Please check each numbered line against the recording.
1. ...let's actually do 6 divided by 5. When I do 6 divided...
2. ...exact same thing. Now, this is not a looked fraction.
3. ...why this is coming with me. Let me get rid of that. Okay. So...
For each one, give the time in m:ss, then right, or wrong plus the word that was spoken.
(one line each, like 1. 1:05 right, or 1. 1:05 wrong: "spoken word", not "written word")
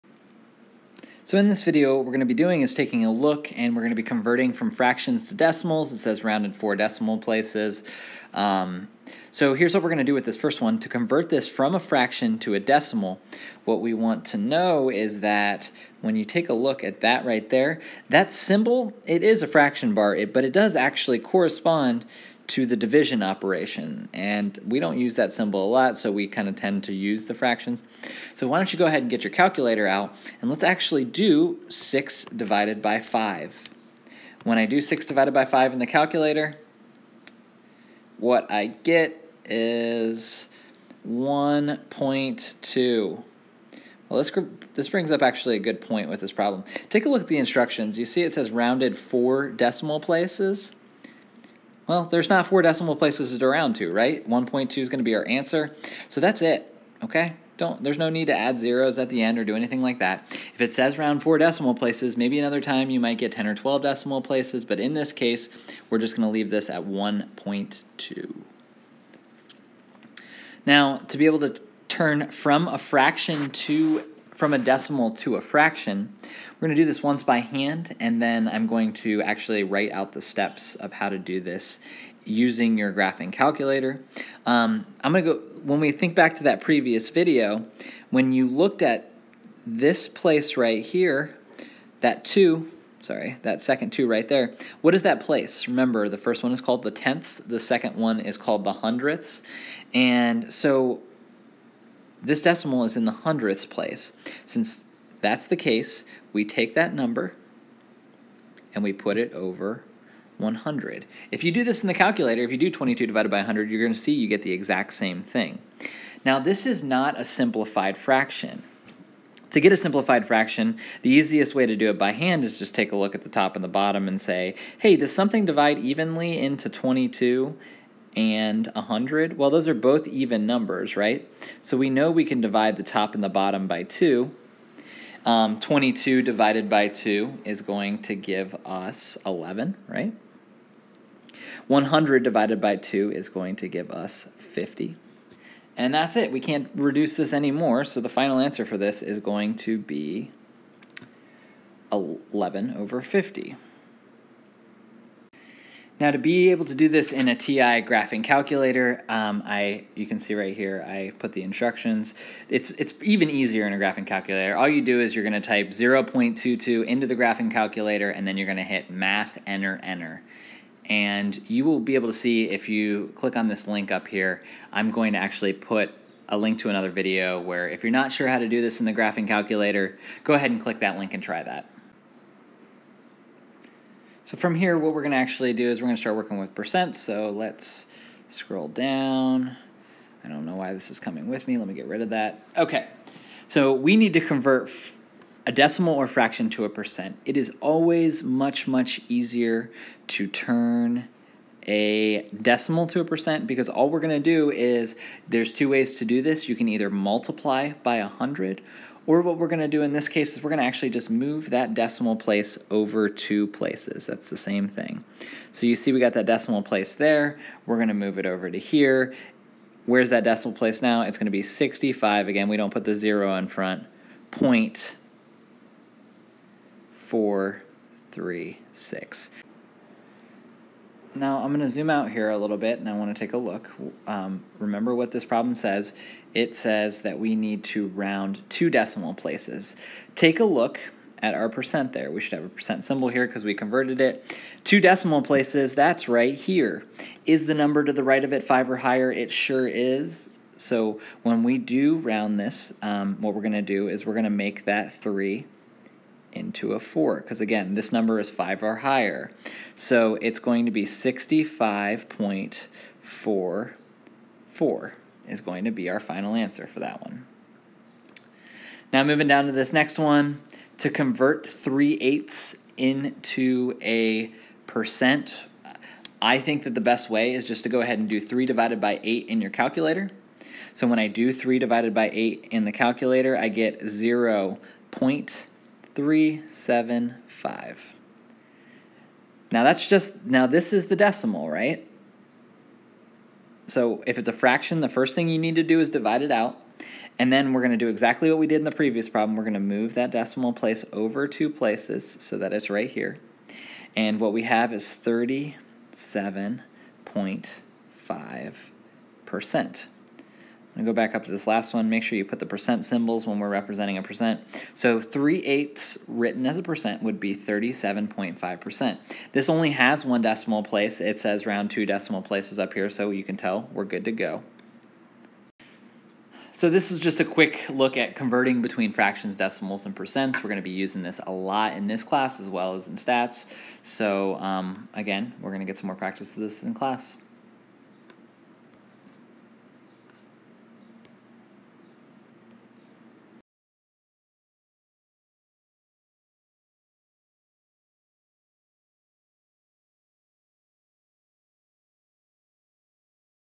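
1. 0:30 right
2. 1:54 wrong: "simplified", not "looked"
3. 3:10 right.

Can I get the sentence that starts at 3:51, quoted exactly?
Now I'm going to zoom out here a little bit and I want to take a look.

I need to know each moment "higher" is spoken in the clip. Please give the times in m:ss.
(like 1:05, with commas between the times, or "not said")
4:08, 4:18.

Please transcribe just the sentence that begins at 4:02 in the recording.
We should have a percent symbol here because we converted it.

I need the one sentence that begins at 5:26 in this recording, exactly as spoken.
So this is just a quick look at converting between fractions, decimals, and percents.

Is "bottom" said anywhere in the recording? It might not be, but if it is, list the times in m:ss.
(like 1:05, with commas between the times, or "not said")
2:03, 2:13.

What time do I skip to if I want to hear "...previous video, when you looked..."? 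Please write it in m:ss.
1:26.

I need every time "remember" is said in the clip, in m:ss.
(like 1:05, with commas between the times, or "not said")
1:35, 3:54.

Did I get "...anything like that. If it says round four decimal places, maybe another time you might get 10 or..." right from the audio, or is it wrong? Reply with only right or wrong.
right.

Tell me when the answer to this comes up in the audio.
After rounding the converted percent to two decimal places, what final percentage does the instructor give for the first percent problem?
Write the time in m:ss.
4:20.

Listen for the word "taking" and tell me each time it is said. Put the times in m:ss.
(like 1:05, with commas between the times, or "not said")
0:02.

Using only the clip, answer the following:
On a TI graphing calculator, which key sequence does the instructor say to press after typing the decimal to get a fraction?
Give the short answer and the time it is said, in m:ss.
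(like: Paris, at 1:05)
math enter enter, at 2:48.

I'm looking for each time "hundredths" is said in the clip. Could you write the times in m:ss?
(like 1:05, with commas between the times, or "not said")
1:38, 1:43.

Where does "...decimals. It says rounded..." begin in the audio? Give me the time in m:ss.
0:05.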